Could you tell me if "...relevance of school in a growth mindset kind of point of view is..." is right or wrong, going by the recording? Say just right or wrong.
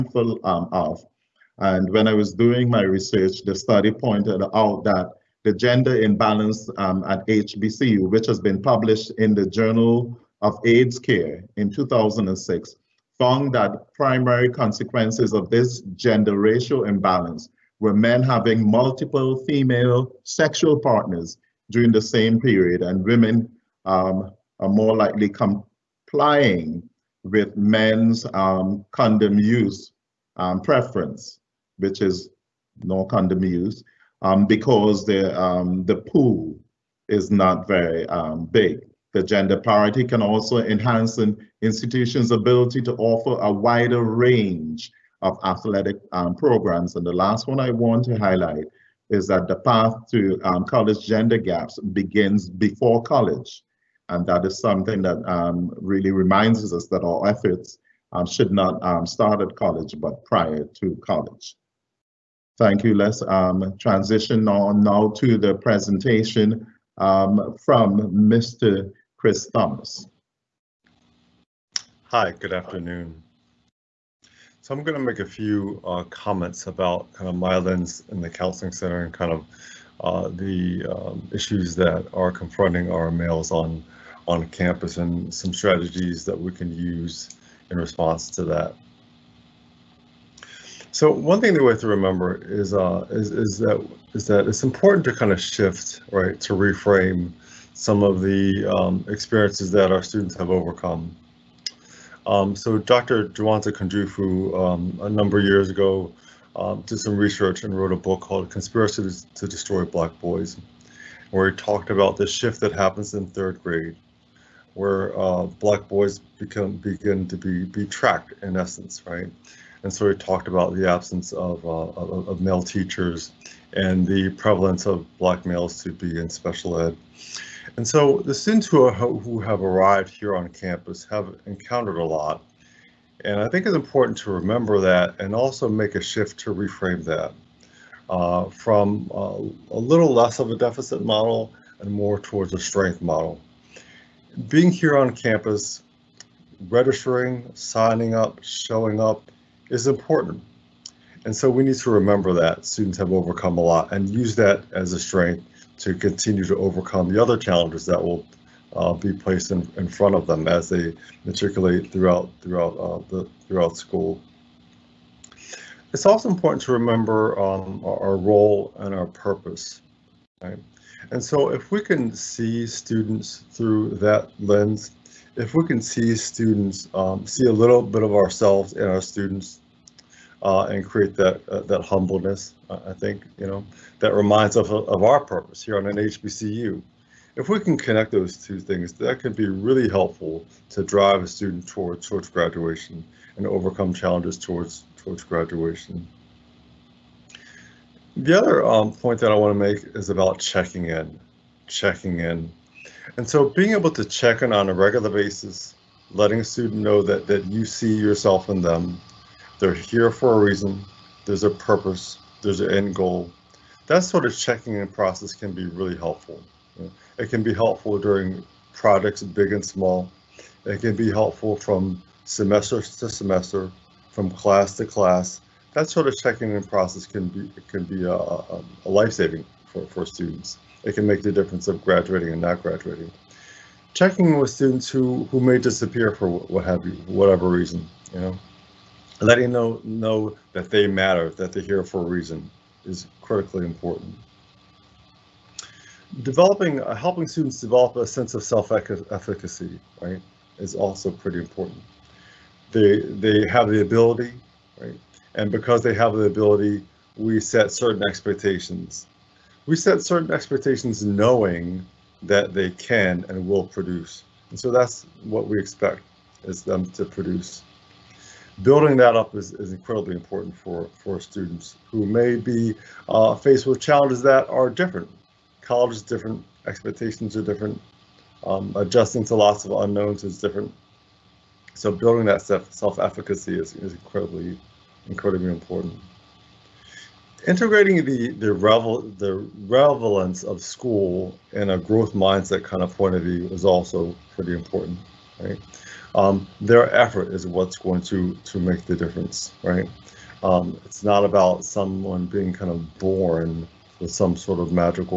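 right.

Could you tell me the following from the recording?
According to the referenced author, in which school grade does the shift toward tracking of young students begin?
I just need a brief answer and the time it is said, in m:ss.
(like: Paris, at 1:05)
third grade, at 1:53.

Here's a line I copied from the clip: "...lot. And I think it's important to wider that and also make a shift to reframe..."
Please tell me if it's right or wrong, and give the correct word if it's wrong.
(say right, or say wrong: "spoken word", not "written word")
wrong: "remember", not "wider".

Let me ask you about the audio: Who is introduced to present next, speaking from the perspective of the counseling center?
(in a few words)
Chris Thomas.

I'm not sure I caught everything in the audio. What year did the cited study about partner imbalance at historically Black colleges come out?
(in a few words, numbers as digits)
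2006.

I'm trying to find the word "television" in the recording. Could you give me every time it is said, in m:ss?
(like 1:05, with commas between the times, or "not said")
not said.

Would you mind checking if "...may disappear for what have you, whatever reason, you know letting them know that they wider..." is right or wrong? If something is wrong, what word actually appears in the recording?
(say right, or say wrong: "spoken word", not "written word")
wrong: "matter", not "wider".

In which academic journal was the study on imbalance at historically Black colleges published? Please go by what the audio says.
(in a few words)
Journal of AIDS Care.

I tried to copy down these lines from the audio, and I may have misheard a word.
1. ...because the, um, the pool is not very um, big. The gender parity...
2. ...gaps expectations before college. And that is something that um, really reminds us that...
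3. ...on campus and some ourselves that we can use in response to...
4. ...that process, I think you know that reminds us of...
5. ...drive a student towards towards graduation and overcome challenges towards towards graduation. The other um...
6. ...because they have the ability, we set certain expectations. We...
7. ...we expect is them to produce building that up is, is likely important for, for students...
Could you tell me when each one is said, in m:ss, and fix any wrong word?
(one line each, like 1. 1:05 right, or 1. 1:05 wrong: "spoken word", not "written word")
1. 0:34 right
2. 0:51 wrong: "begins", not "expectations"
3. 1:24 wrong: "strategies", not "ourselves"
4. 3:01 wrong: "humbleness", not "process"
5. 3:10 right
6. 4:15 right
7. 4:25 wrong: "incredibly", not "likely".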